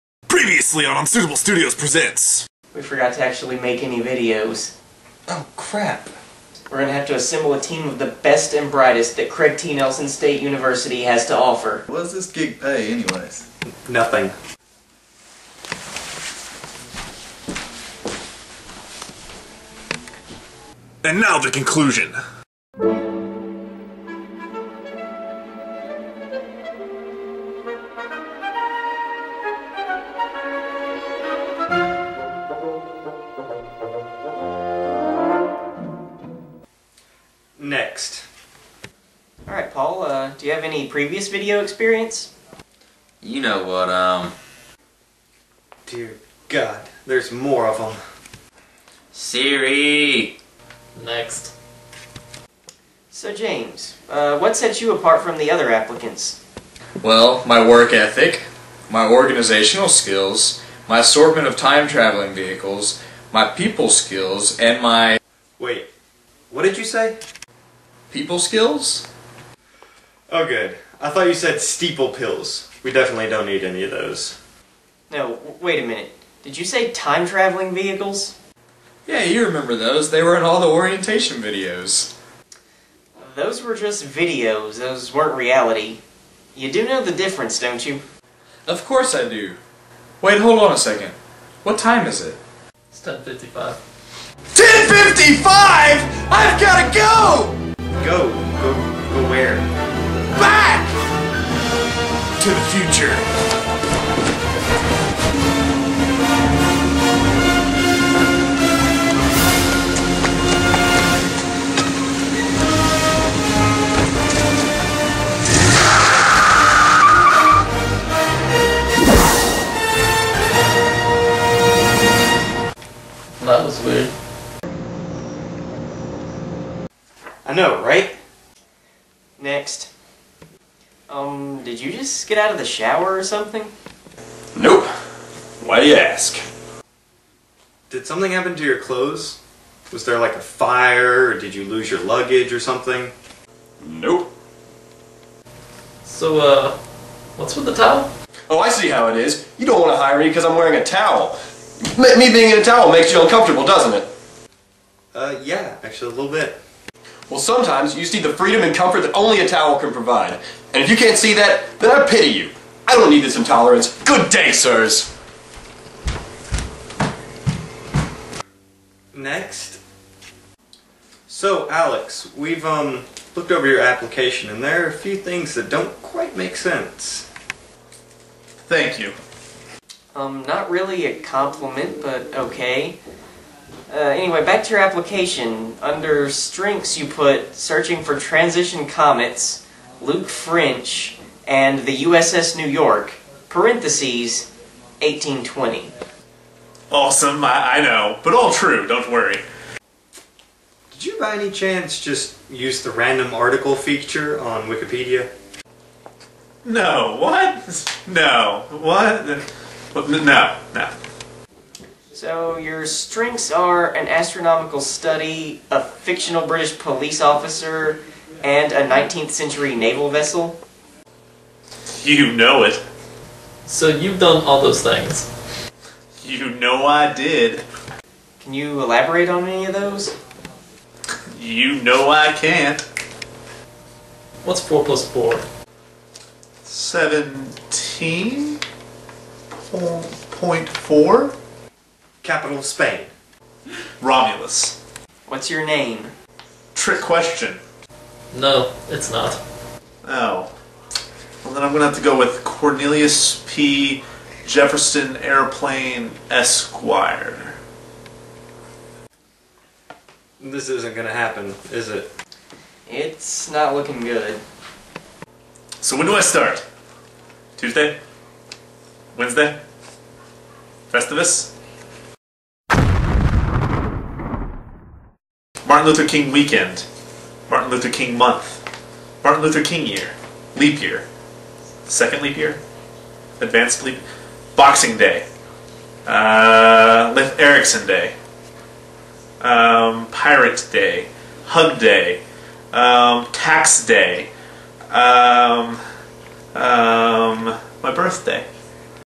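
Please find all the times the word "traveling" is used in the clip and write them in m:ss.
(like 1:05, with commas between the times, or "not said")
1:01, 1:17.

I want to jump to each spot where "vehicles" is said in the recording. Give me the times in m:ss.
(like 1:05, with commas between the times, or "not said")
1:02, 1:17.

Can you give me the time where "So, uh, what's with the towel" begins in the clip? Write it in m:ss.
2:26.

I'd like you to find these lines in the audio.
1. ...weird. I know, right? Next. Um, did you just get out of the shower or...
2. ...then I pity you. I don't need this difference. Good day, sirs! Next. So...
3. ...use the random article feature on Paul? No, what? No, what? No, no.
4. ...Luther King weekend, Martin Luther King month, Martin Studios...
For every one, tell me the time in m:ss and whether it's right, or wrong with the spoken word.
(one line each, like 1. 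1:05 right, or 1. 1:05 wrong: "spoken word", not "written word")
1. 2:03 right
2. 2:41 wrong: "intolerance", not "difference"
3. 3:22 wrong: "Wikipedia", not "Paul"
4. 4:35 wrong: "Luther", not "Studios".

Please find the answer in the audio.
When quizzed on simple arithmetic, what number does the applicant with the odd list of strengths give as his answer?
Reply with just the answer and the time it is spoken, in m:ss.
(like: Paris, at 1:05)
17.4, at 3:56.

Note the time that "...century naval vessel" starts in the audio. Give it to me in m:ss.
3:39.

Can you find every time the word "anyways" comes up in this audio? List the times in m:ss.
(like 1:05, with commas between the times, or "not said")
0:12, 3:03.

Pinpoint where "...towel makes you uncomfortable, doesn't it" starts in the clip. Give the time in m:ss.
2:32.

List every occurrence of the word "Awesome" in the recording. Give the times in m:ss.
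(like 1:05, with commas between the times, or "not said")
3:16.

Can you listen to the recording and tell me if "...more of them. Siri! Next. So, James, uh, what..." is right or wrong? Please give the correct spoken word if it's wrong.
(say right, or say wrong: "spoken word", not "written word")
right.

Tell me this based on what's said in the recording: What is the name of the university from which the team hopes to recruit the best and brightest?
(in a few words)
Craig T. Nelson State University.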